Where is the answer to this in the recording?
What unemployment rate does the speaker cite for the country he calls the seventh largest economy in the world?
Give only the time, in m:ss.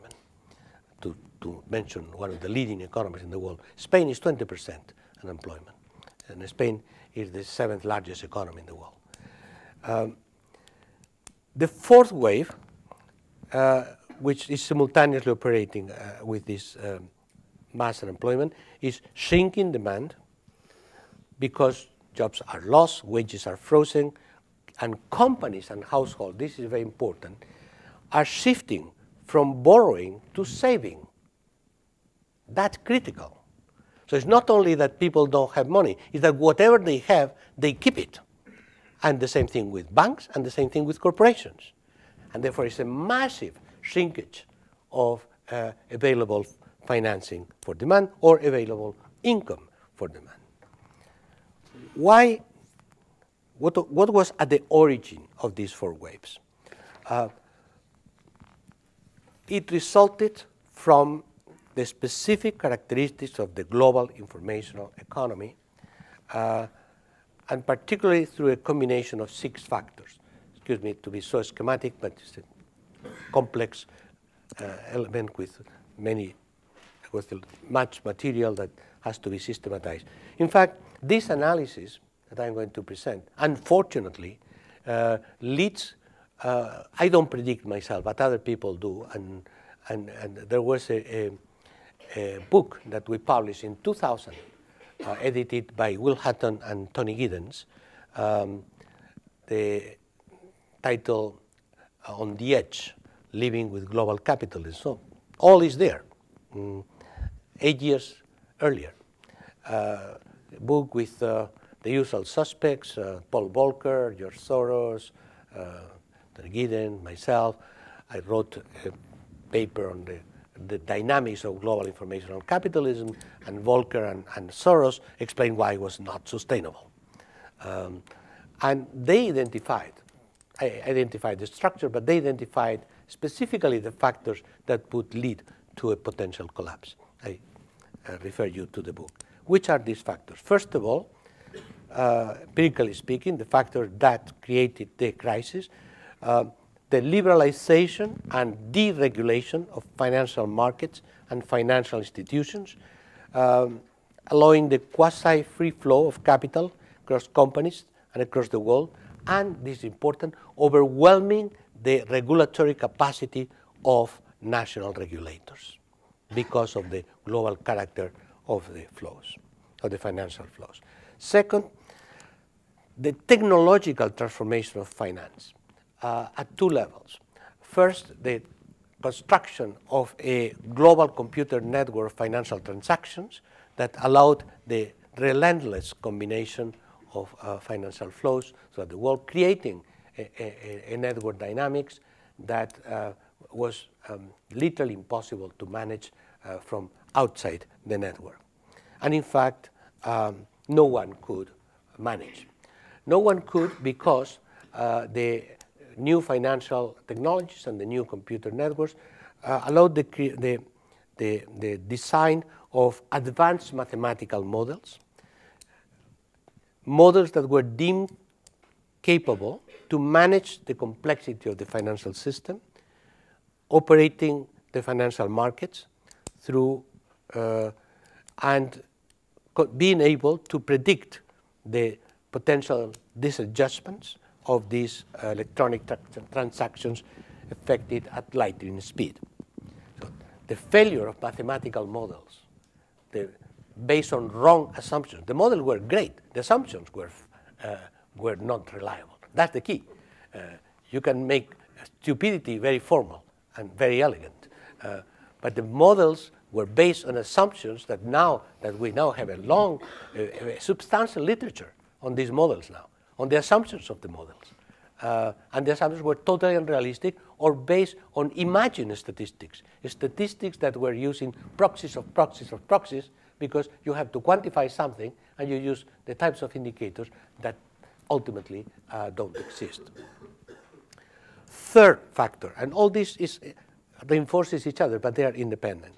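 0:04.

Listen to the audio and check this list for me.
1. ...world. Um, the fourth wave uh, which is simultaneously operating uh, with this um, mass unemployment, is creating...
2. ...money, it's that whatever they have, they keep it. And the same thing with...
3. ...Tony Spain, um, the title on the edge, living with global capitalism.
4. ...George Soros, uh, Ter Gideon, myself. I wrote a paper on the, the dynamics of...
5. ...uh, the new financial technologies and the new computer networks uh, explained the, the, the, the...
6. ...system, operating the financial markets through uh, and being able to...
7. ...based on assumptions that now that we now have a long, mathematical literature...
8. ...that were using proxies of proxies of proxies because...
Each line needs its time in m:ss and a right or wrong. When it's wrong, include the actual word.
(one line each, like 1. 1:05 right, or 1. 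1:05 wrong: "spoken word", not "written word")
1. 0:08 wrong: "shrinking", not "creating"
2. 0:35 right
3. 1:36 wrong: "Giddens", not "Spain"
4. 1:54 right
5. 3:24 wrong: "allowed", not "explained"
6. 3:42 right
7. 4:16 wrong: "substantial", not "mathematical"
8. 4:30 right.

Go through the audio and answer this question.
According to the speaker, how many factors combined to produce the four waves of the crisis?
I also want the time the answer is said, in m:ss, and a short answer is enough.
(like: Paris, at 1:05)
6, at 1:09.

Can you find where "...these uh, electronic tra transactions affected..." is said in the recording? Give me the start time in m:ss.
3:54.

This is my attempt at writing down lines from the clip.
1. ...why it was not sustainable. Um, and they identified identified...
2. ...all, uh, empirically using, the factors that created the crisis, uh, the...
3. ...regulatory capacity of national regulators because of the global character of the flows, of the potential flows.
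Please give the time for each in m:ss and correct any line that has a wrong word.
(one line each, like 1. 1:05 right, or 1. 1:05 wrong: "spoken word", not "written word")
1. 2:05 right
2. 2:20 wrong: "speaking", not "using"
3. 2:42 wrong: "financial", not "potential".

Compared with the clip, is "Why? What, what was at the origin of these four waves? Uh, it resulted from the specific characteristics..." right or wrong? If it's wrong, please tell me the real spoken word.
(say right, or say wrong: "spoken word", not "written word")
right.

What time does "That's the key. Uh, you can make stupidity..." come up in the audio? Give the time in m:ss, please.
4:09.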